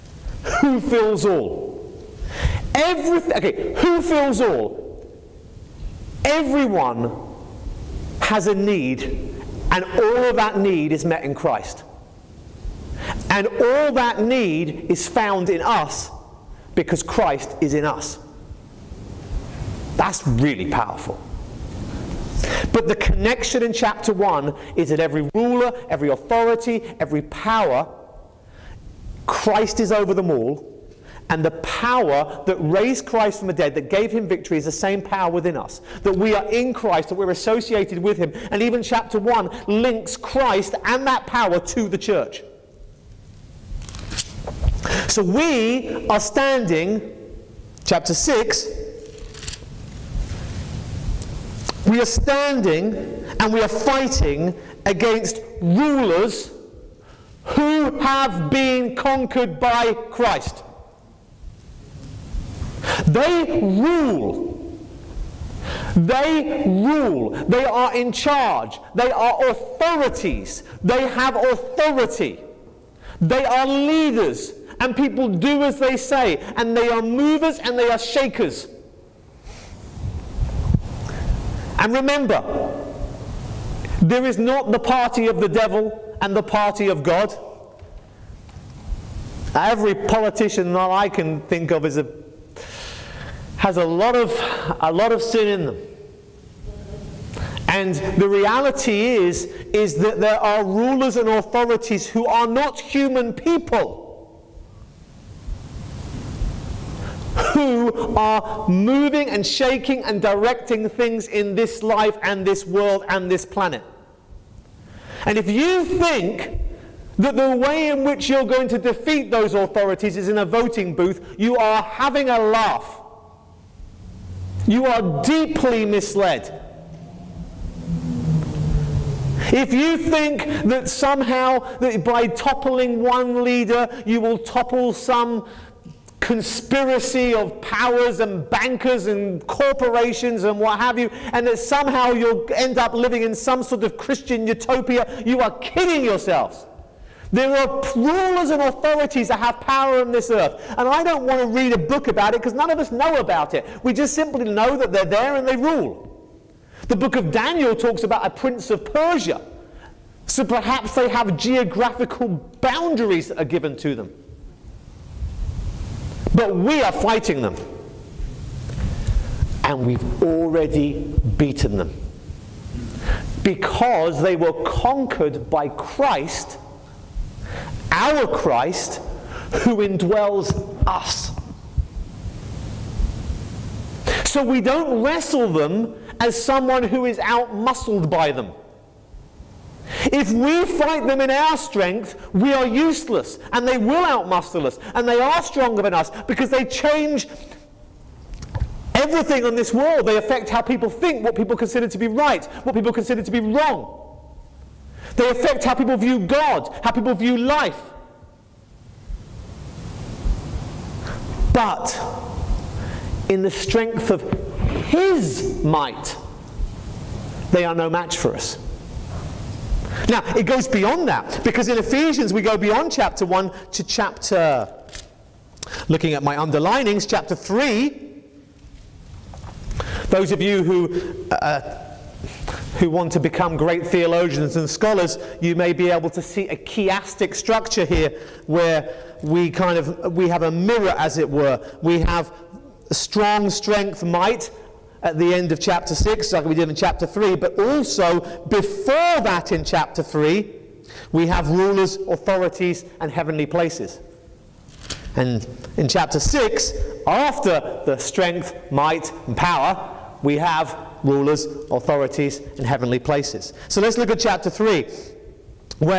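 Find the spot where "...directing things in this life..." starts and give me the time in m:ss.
1:50.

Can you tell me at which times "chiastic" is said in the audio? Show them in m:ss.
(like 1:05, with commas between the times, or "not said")
3:56.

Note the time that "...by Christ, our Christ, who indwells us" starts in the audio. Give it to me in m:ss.
2:55.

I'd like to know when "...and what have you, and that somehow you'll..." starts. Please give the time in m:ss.
2:20.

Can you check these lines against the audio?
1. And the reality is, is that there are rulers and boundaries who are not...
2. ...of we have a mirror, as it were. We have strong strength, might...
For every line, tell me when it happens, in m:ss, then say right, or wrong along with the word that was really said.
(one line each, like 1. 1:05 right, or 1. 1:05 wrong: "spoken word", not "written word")
1. 1:37 wrong: "authorities", not "boundaries"
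2. 3:59 right.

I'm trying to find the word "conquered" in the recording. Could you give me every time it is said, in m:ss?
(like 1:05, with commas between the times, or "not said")
0:58, 2:54.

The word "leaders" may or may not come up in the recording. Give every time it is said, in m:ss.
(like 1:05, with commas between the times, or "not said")
1:13, 2:13.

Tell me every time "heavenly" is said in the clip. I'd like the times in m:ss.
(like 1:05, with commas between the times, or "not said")
4:13, 4:22.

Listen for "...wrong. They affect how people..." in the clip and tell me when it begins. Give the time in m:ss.
3:23.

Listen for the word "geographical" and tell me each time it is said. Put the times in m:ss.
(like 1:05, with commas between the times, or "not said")
2:41.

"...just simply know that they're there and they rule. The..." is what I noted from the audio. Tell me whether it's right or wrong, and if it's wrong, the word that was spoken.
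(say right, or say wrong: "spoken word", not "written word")
right.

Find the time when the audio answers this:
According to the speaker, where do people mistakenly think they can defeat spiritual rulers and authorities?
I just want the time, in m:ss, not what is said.
2:00.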